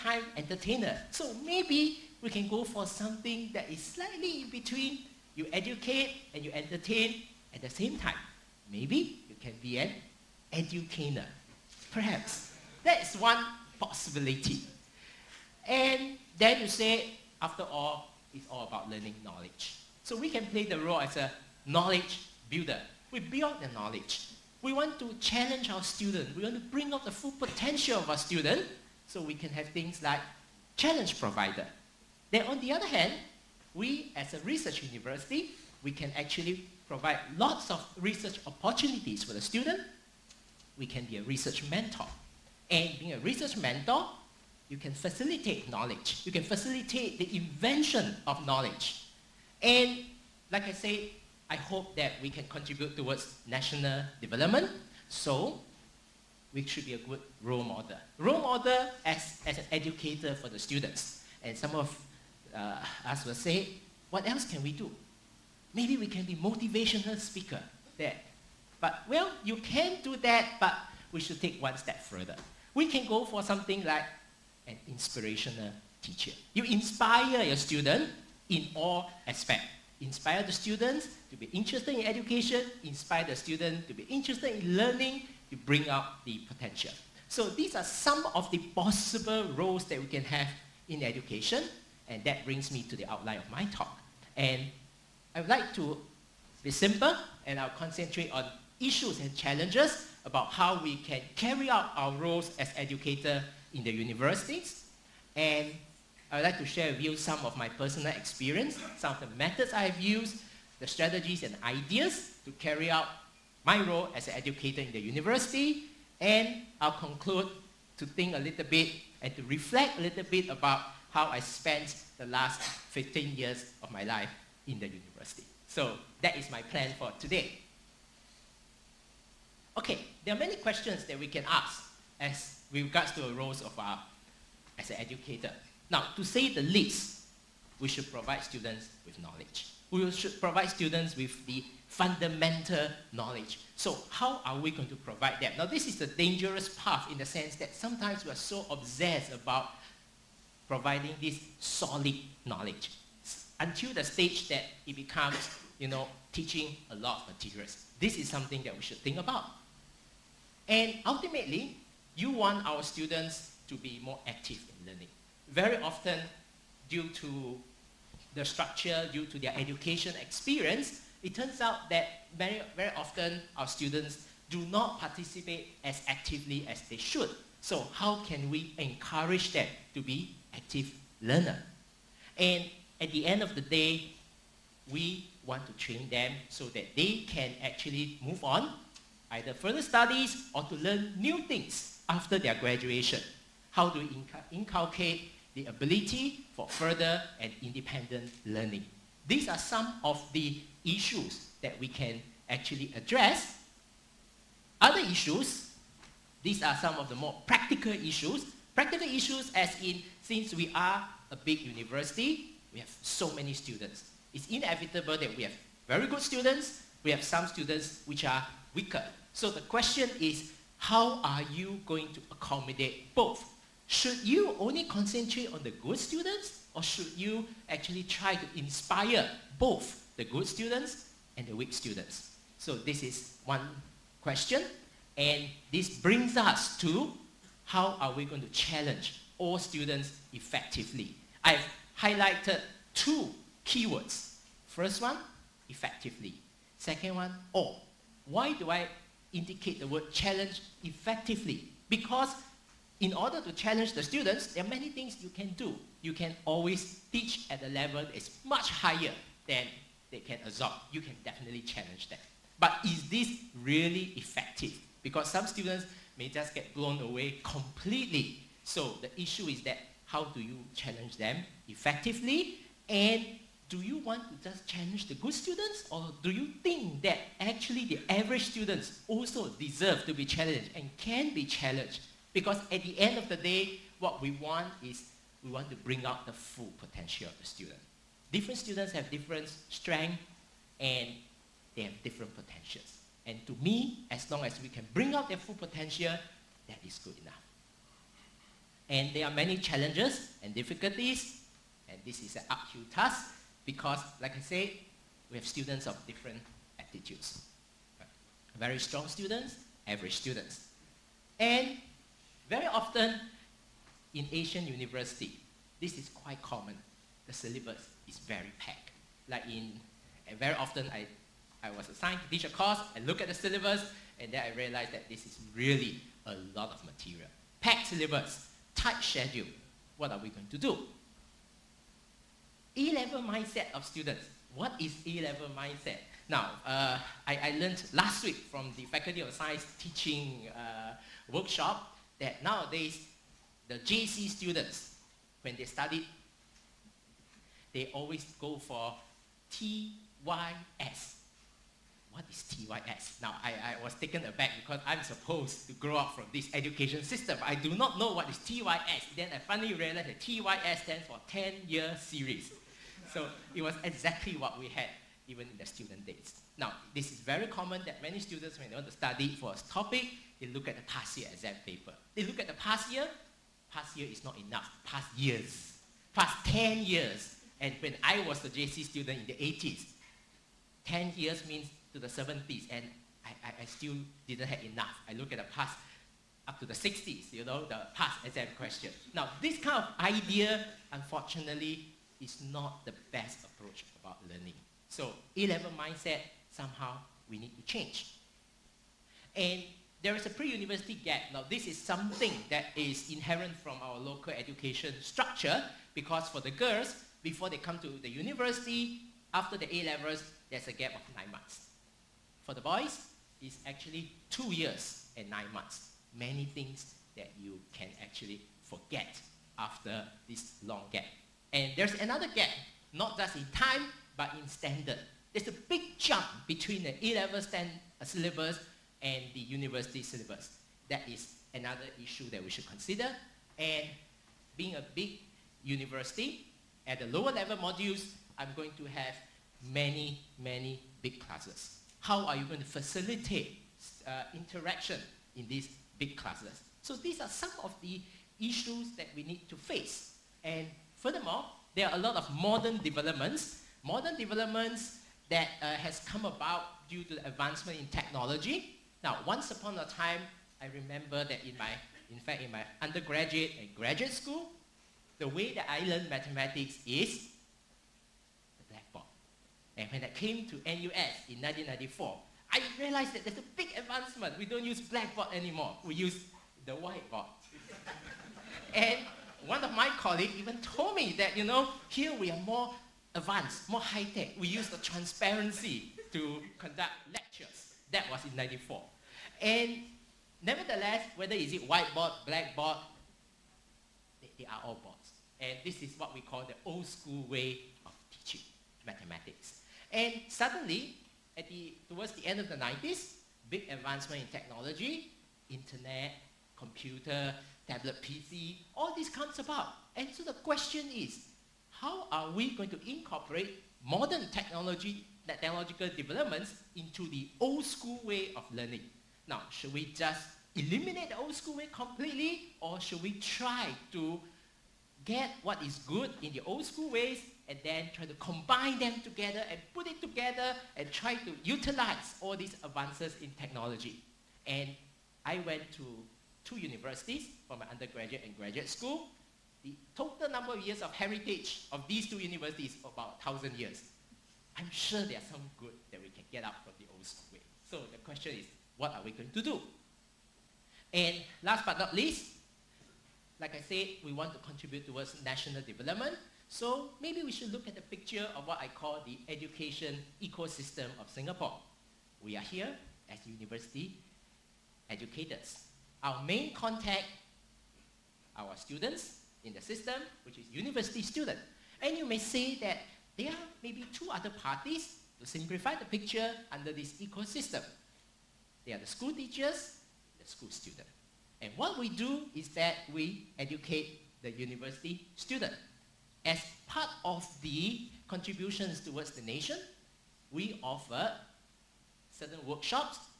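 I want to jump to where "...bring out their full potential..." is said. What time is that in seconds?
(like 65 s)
294 s.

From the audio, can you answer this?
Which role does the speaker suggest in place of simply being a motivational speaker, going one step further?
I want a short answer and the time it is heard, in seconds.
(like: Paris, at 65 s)
inspirational teacher, at 74 s.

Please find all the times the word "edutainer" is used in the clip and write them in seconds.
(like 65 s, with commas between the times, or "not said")
10 s.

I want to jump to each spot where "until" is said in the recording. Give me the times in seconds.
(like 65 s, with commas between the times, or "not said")
153 s.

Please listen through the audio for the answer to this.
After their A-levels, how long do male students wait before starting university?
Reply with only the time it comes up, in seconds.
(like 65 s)
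414 s.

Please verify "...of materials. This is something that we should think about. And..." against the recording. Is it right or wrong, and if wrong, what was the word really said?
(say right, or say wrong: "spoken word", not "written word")
right.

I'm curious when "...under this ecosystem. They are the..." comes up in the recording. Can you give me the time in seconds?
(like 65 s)
576 s.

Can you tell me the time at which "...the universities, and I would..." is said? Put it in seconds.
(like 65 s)
103 s.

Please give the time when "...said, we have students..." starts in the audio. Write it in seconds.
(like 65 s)
304 s.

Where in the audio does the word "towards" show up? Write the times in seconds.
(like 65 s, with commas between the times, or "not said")
52 s, 501 s, 554 s, 588 s.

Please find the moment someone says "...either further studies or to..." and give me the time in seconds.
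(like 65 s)
189 s.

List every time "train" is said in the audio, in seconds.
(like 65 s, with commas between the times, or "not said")
185 s.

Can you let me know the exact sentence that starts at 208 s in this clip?
Practical issues as in, since we are a big university, we have so many students.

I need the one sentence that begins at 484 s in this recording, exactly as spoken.
We used the transparency to conduct lectures.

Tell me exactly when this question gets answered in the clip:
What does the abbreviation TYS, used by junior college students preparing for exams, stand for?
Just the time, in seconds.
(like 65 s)
361 s.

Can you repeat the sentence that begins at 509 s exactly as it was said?
And so the question is, how are we going to incorporate modern technology, technological developments into the old school way of learning?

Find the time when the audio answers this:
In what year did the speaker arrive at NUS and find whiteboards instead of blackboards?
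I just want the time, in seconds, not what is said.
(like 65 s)
471 s.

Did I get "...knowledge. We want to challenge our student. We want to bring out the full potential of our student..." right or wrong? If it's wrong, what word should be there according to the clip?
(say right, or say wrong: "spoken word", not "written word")
right.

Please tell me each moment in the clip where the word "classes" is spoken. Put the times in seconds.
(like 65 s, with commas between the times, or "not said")
441 s, 446 s.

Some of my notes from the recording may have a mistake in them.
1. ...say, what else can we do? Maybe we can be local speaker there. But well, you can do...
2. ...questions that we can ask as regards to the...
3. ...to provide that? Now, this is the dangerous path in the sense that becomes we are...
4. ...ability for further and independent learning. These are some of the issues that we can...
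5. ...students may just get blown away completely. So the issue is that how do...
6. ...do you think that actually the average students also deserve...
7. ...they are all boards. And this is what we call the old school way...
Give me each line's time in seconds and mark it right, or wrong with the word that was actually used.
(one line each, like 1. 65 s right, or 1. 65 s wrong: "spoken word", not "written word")
1. 63 s wrong: "motivational", not "local"
2. 130 s right
3. 144 s wrong: "sometimes", not "becomes"
4. 195 s right
5. 265 s right
6. 276 s right
7. 494 s right.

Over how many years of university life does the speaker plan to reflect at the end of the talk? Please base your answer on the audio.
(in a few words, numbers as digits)
15.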